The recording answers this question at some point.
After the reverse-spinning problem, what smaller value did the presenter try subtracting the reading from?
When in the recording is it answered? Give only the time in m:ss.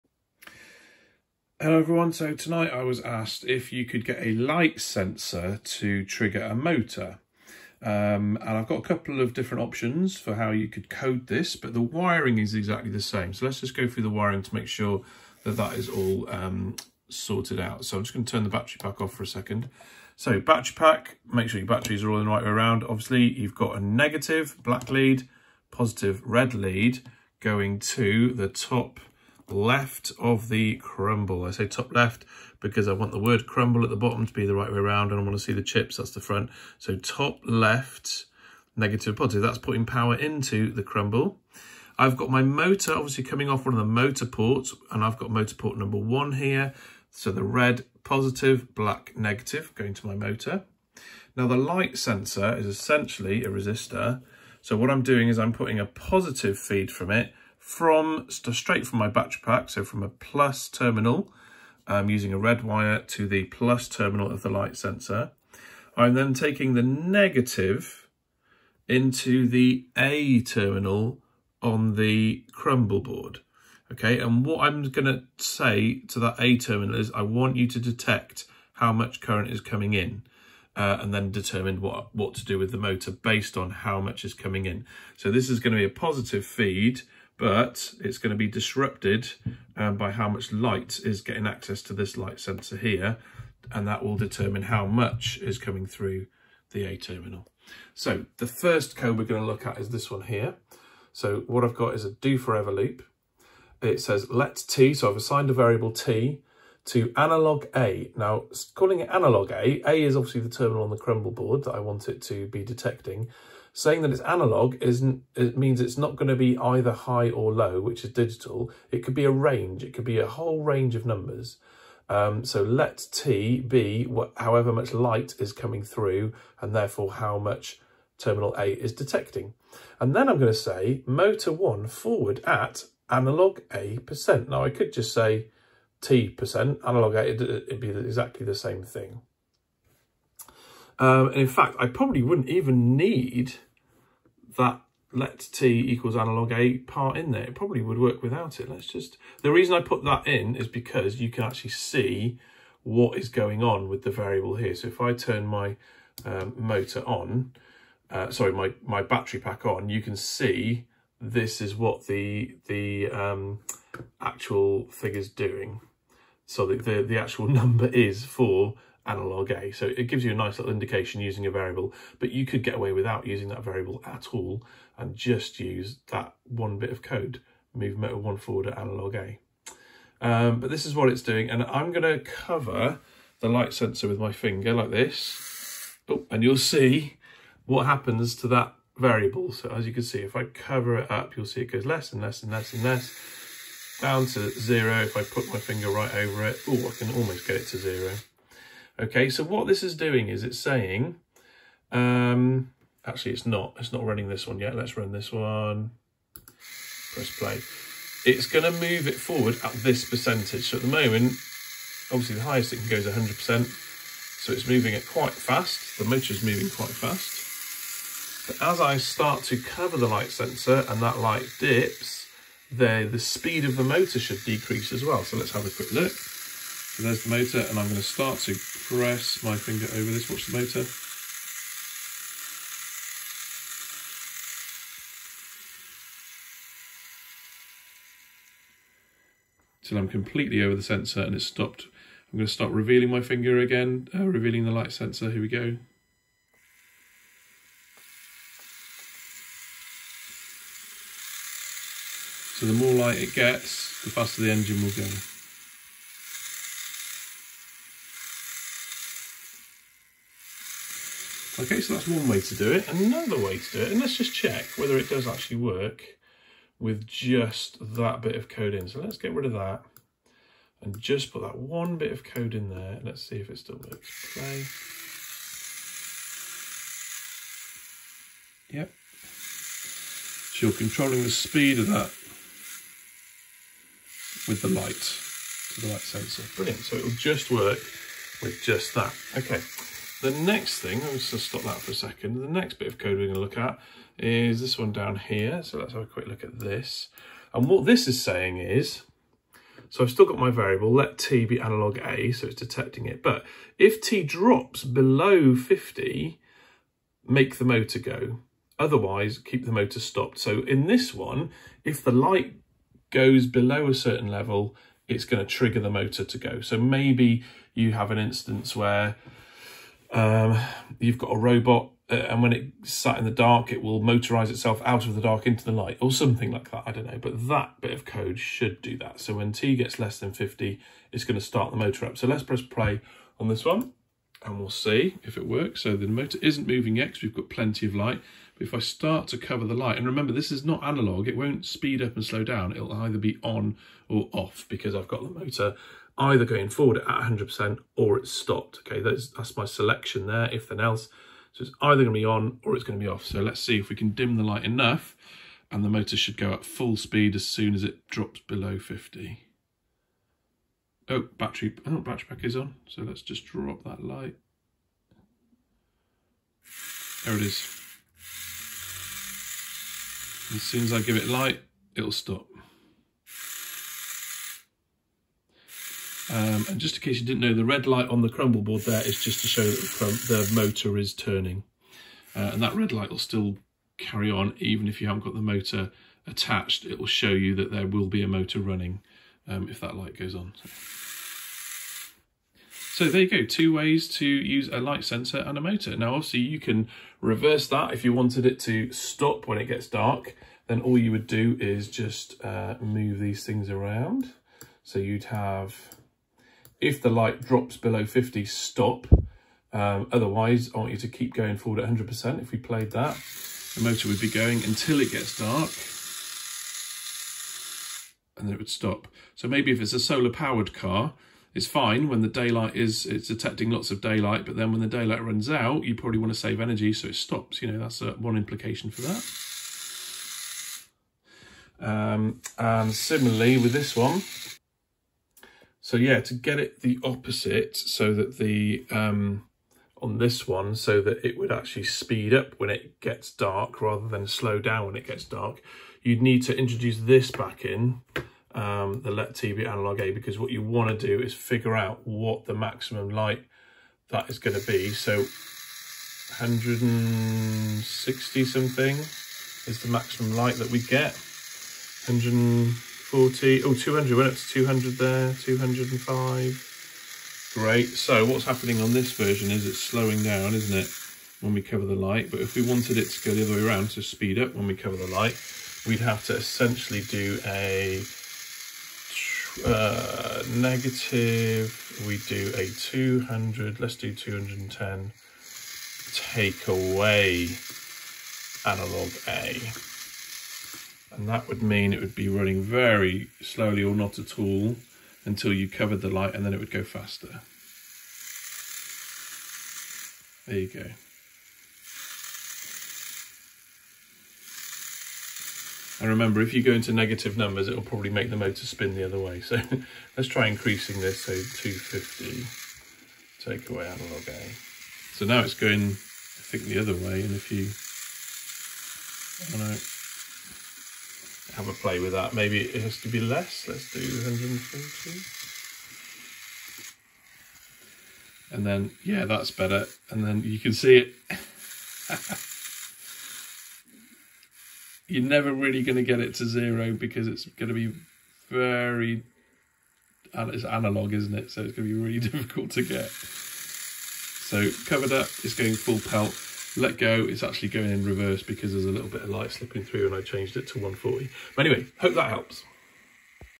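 8:43.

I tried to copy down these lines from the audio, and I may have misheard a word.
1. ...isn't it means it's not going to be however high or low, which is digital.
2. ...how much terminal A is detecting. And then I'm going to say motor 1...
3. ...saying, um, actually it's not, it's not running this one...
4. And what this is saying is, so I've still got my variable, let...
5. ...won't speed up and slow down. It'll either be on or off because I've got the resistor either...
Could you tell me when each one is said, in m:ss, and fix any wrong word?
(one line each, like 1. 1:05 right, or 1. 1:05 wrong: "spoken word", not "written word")
1. 1:54 wrong: "either", not "however"
2. 2:07 right
3. 3:20 right
4. 4:57 right
5. 5:41 wrong: "motor", not "resistor".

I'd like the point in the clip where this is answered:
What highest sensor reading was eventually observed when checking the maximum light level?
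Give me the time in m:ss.
7:45.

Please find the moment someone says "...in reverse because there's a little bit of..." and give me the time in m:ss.
9:07.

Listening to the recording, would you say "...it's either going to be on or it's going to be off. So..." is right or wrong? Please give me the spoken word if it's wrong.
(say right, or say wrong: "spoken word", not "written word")
right.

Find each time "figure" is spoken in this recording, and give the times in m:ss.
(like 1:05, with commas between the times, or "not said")
2:44, 7:31.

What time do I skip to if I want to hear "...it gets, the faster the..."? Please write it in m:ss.
4:13.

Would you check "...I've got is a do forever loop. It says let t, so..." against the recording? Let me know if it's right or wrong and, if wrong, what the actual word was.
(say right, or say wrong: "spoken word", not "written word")
right.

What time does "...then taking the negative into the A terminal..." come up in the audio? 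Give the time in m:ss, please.
1:06.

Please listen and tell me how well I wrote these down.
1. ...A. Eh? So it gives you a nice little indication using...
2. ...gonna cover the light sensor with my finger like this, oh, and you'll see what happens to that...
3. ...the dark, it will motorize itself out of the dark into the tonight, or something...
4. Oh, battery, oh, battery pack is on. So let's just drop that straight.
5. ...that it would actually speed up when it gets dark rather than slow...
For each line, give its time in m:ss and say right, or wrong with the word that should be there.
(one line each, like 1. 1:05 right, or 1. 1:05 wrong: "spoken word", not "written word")
1. 2:49 right
2. 3:01 right
3. 5:23 wrong: "light", not "tonight"
4. 6:01 wrong: "light", not "straight"
5. 7:21 right.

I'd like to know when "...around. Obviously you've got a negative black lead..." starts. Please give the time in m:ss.
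0:22.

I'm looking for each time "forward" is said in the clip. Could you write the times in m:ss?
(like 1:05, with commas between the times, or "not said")
2:11, 2:58, 3:29, 5:46, 6:51.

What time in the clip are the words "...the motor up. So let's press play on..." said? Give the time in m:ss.
5:31.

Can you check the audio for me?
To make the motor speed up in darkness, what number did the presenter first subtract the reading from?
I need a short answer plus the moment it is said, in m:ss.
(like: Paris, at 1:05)
210, at 8:04.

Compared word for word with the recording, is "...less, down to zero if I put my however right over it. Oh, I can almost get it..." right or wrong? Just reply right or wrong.
wrong.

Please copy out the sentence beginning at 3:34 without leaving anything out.
So it's moving it quite fast.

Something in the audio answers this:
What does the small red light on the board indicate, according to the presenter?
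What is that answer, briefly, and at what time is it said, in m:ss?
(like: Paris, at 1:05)
the motor is turning, at 6:20.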